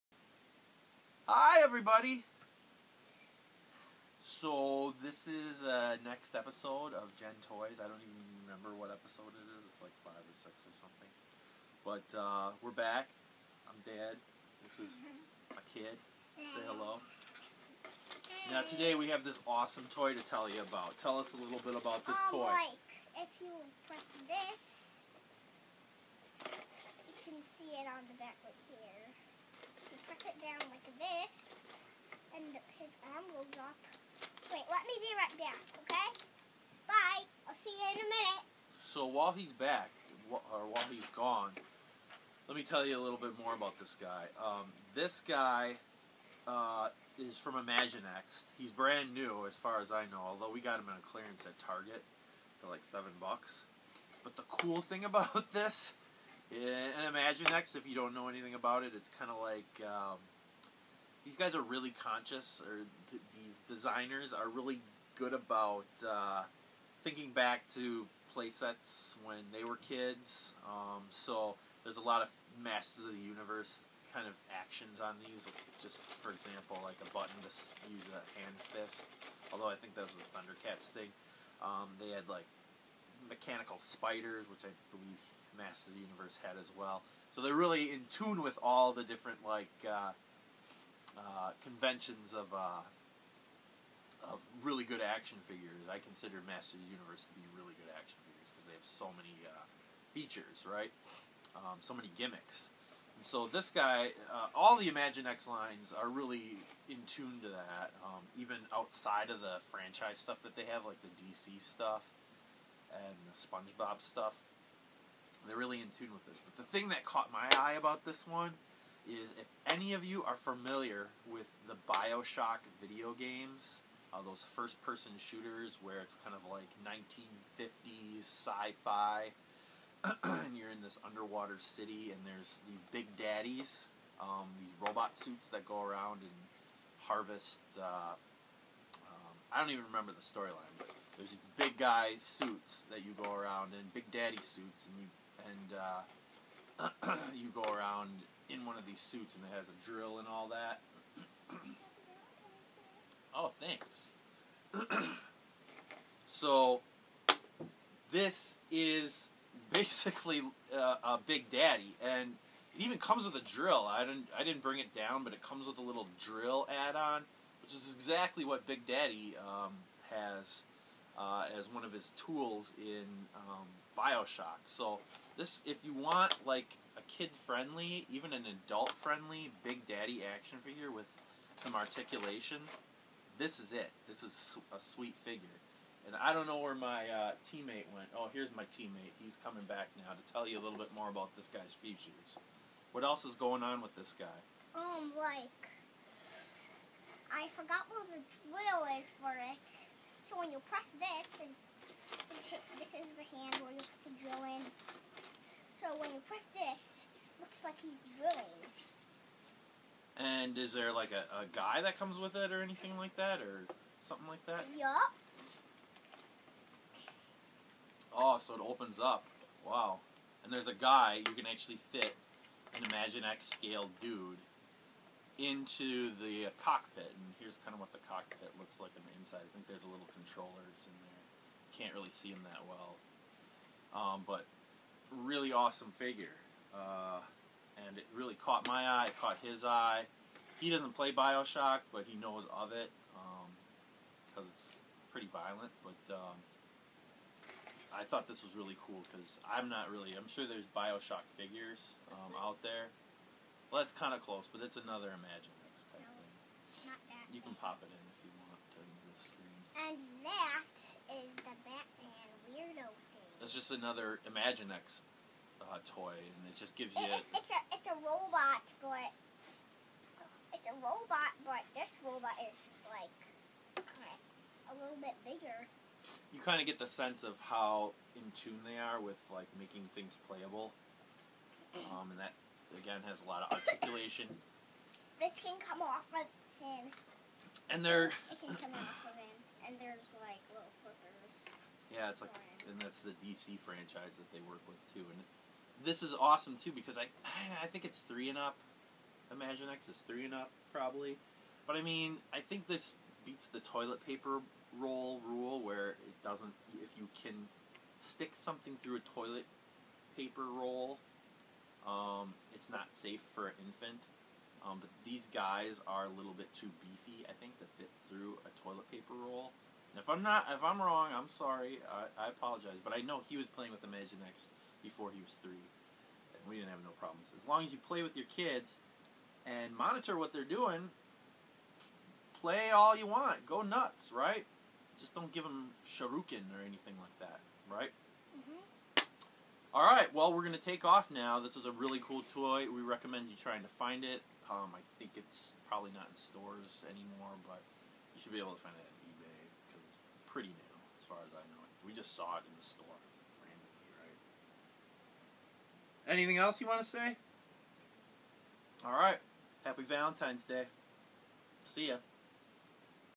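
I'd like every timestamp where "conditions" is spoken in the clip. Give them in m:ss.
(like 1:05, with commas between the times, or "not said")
not said.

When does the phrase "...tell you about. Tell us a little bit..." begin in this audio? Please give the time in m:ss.
0:20.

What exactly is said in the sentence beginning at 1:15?
Just for example, like a button to use a hand fist.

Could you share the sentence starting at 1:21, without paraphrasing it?
Um, they had like mechanical spiders, which I believe Masters of the Universe had as well.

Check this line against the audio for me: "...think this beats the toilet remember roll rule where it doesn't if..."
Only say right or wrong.
wrong.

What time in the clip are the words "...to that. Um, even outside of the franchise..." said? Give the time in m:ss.
1:47.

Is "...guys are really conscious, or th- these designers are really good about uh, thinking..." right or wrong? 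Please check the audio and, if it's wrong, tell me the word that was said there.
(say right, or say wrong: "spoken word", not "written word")
right.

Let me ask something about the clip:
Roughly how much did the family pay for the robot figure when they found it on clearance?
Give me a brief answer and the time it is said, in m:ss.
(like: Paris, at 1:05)
$7, at 0:52.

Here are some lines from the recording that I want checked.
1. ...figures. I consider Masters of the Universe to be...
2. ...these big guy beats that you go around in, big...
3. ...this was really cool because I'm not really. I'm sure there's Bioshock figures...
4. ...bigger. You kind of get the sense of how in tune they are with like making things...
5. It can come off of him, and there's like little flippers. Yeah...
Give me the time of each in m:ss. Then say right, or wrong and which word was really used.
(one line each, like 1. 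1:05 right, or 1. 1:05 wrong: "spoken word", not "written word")
1. 1:35 right
2. 2:21 wrong: "suits", not "beats"
3. 4:08 right
4. 4:35 right
5. 4:48 right.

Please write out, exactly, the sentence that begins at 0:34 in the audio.
Wait, let me be right back, okay?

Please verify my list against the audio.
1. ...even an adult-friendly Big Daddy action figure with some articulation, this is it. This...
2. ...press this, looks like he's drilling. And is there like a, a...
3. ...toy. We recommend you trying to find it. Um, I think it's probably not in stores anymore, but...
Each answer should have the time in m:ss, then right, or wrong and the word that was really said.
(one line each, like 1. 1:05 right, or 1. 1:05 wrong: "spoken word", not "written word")
1. 2:58 right
2. 3:26 right
3. 5:42 right.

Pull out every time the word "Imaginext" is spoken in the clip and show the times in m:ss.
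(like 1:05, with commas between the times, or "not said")
0:47, 0:57, 1:44, 3:42, 4:15, 4:24, 4:59, 5:23.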